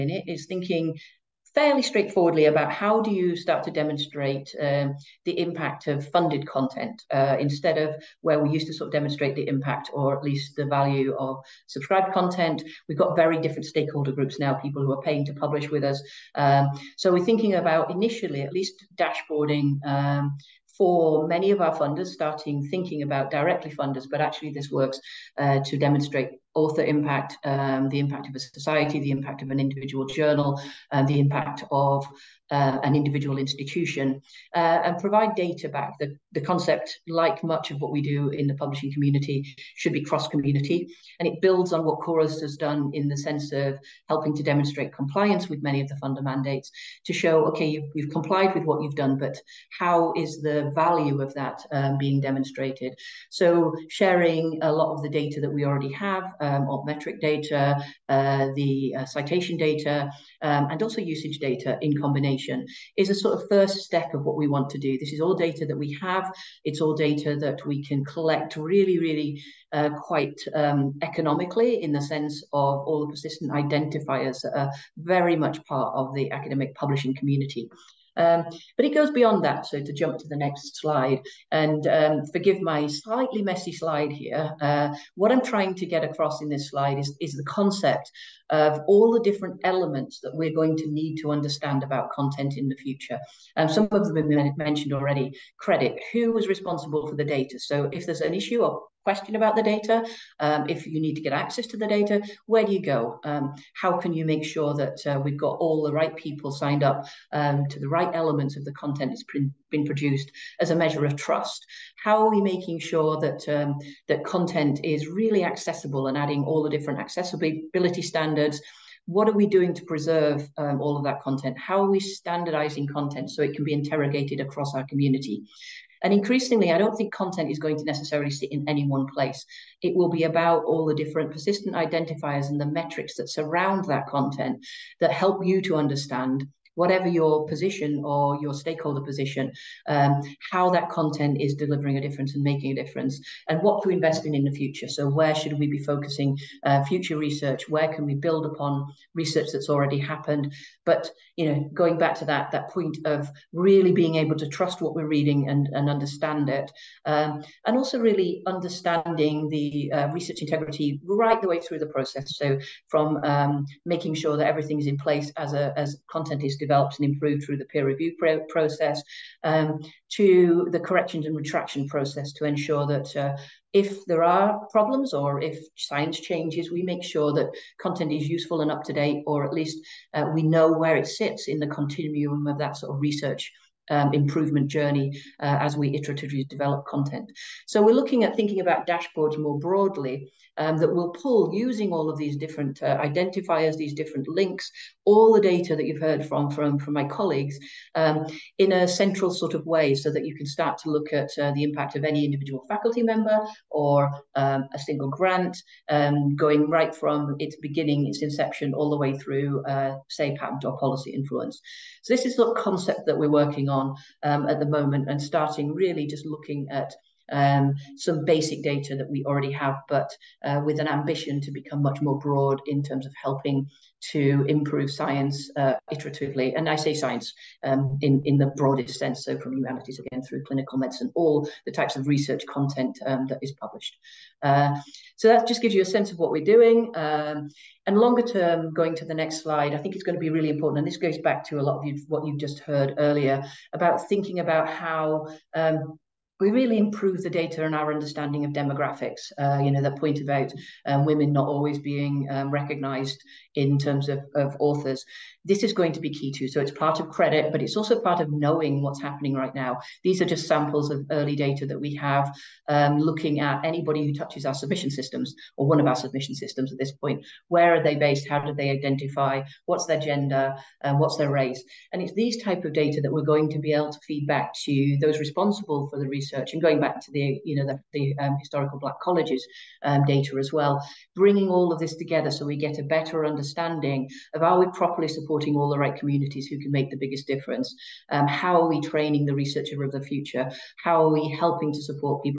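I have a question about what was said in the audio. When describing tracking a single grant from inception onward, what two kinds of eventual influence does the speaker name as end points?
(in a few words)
Patent or policy influence.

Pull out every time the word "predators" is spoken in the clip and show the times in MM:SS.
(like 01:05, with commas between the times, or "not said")
not said.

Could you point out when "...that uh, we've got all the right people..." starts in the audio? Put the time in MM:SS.
01:44.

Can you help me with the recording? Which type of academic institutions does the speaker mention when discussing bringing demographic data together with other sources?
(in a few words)
Historical black colleges.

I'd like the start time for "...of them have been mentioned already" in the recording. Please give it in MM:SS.
01:33.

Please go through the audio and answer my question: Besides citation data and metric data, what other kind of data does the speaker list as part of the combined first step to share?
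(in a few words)
Usage data.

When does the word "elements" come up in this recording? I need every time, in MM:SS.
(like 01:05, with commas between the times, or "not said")
01:29, 01:48.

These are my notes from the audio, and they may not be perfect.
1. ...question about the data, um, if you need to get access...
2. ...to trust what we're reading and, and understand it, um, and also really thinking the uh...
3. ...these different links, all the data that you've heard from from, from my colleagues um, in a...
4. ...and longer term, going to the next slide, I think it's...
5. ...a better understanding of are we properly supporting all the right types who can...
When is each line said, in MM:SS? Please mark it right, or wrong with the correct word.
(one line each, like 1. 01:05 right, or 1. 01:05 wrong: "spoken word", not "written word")
1. 01:39 right
2. 02:34 wrong: "understanding", not "thinking"
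3. 03:13 right
4. 03:57 right
5. 04:42 wrong: "communities", not "types".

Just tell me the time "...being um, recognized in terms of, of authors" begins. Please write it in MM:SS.
04:11.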